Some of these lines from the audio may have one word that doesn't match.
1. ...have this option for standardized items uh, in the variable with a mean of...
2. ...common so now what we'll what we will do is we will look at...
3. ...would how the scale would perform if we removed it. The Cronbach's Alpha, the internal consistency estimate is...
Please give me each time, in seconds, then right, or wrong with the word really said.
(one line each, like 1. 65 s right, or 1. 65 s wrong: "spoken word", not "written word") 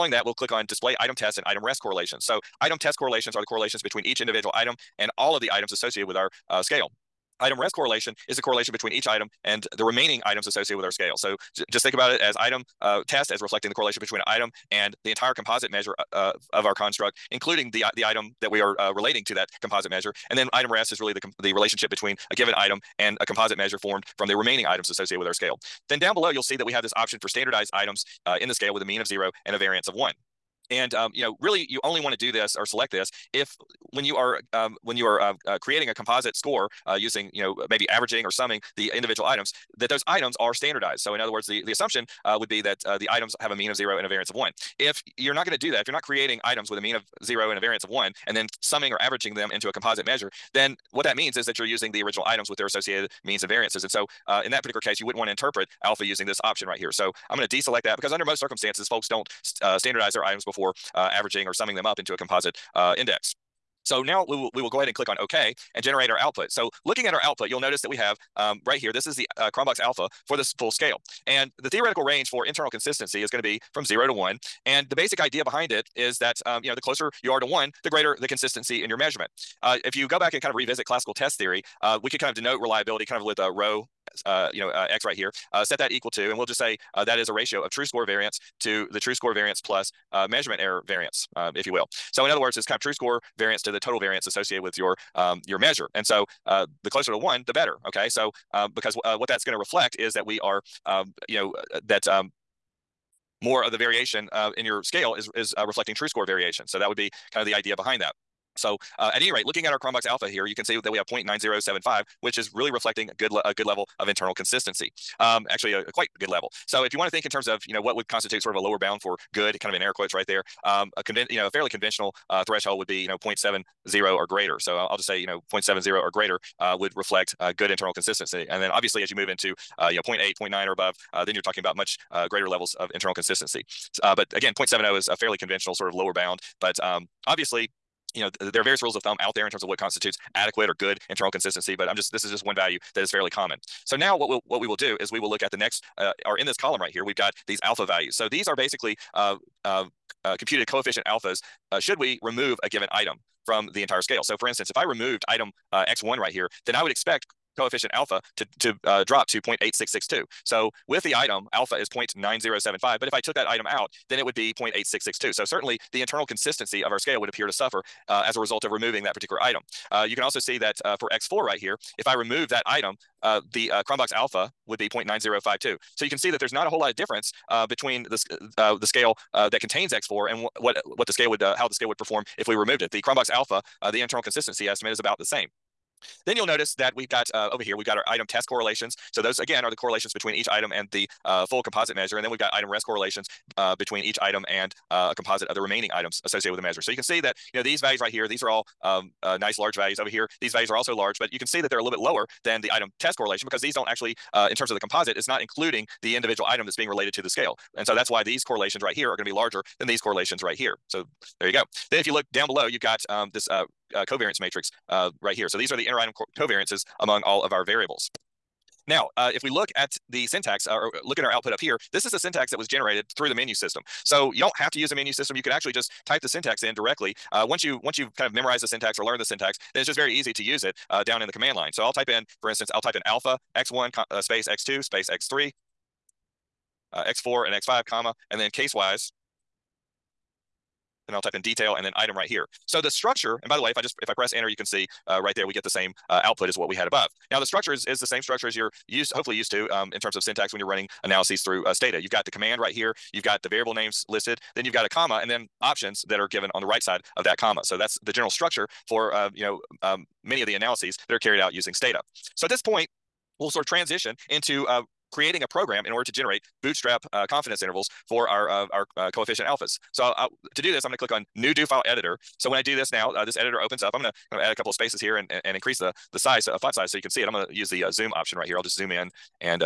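1. 26 s wrong: "scale", not "variable"
2. 143 s right
3. 181 s right.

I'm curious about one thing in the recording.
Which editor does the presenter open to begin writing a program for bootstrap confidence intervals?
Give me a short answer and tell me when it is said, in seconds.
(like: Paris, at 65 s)
New Do File Editor, at 271 s.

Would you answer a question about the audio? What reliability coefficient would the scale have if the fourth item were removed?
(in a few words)
0.9052.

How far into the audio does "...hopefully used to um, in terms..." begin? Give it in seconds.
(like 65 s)
249 s.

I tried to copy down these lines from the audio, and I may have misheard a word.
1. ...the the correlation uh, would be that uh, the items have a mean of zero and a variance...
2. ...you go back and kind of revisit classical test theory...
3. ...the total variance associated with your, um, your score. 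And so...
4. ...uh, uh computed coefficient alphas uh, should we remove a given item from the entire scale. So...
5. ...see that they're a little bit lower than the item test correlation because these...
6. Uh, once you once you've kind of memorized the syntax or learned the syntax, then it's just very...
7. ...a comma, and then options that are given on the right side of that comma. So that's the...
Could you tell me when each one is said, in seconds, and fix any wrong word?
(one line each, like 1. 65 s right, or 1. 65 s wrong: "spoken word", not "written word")
1. 41 s wrong: "assumption", not "correlation"
2. 79 s right
3. 93 s wrong: "measure", not "score"
4. 149 s right
5. 201 s right
6. 227 s right
7. 254 s right.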